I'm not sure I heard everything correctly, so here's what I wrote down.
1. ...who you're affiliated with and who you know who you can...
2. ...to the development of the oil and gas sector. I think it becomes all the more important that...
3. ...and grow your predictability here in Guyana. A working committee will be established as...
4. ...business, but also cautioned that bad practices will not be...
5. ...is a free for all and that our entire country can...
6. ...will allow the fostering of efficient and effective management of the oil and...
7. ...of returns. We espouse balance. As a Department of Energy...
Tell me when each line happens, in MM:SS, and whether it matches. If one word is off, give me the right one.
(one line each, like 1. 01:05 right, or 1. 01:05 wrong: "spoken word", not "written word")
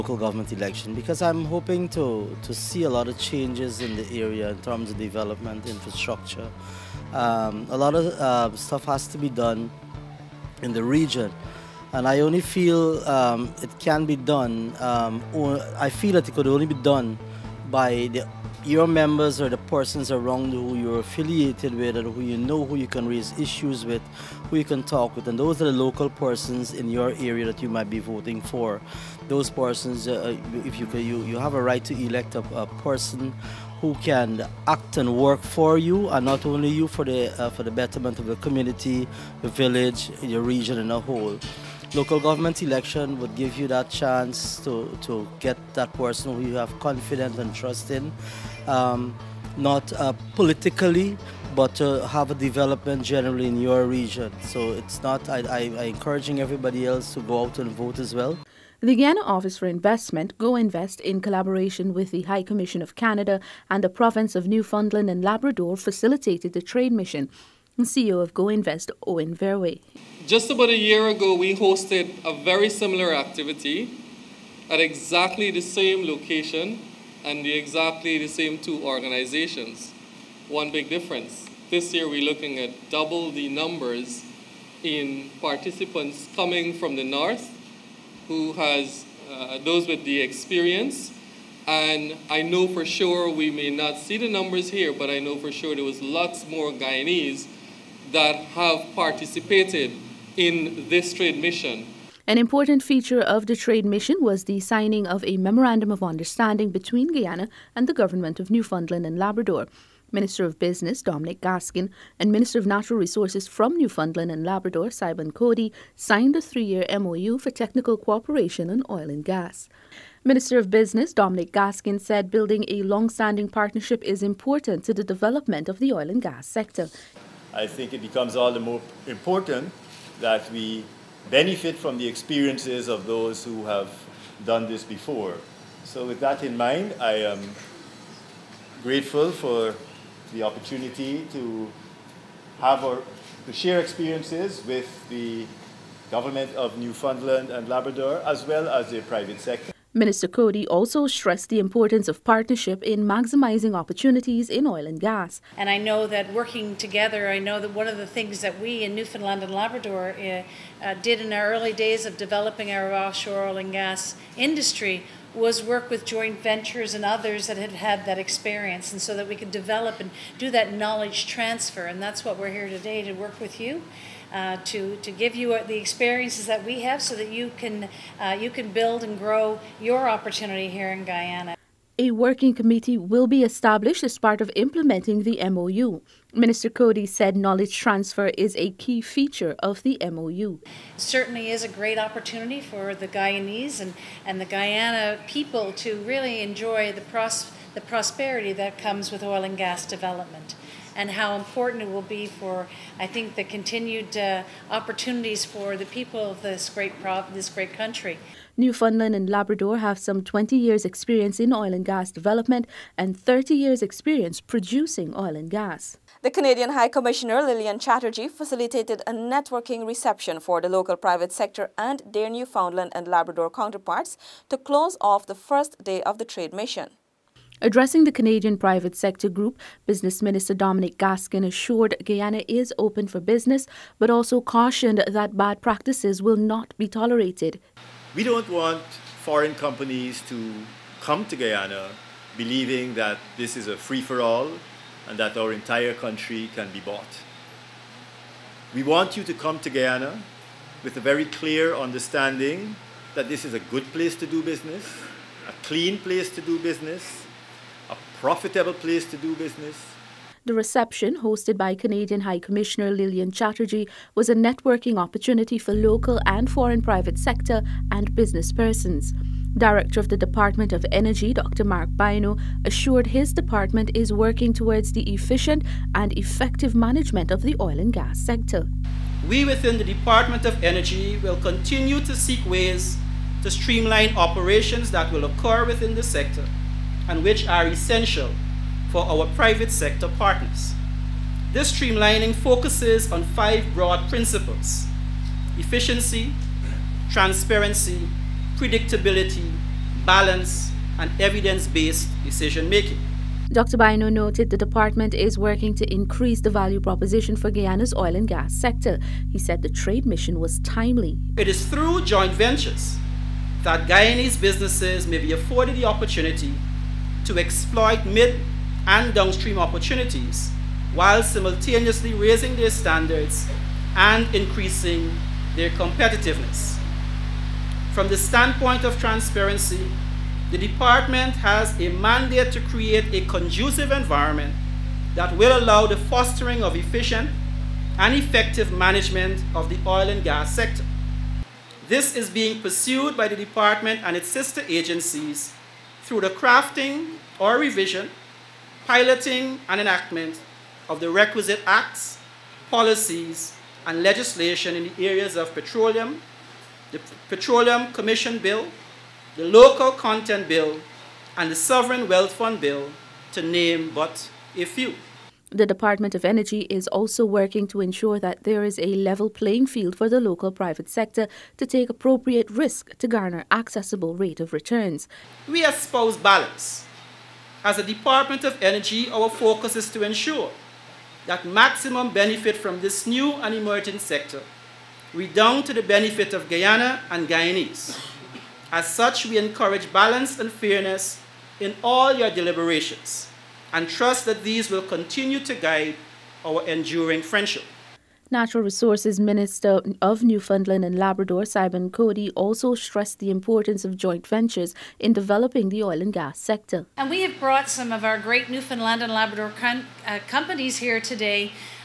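1. 00:20 right
2. 02:04 right
3. 02:59 wrong: "opportunity", not "predictability"
4. 03:53 right
5. 04:03 right
6. 05:35 right
7. 06:14 right.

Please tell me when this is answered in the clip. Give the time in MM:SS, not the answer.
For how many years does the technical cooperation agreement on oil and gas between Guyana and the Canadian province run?
01:56.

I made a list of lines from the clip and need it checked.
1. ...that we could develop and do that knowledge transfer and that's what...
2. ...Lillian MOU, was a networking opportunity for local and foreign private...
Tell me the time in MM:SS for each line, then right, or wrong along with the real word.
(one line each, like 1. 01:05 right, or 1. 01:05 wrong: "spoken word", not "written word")
1. 02:49 right
2. 04:22 wrong: "Chatterjee", not "MOU".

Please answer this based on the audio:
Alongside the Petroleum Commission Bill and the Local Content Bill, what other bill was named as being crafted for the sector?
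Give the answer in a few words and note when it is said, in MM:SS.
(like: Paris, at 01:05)
Sovereign Wealth Fund Bill, at 06:01.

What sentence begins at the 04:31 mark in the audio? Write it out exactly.
Mark Bynoe, assured his department is working towards the efficient and effective management of the oil and gas sector.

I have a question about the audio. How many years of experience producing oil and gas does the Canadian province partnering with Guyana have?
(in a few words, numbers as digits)
30.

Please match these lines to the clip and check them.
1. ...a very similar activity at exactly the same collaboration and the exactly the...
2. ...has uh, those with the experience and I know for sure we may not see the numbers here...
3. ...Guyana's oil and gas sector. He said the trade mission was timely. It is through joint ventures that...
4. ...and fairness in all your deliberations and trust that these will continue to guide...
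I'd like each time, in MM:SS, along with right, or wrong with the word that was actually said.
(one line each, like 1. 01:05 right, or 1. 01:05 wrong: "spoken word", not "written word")
1. 01:12 wrong: "location", not "collaboration"
2. 01:28 right
3. 05:07 right
4. 06:30 right.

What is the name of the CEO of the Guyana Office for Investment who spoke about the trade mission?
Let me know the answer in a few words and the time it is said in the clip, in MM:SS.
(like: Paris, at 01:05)
Owen Verwey, at 01:09.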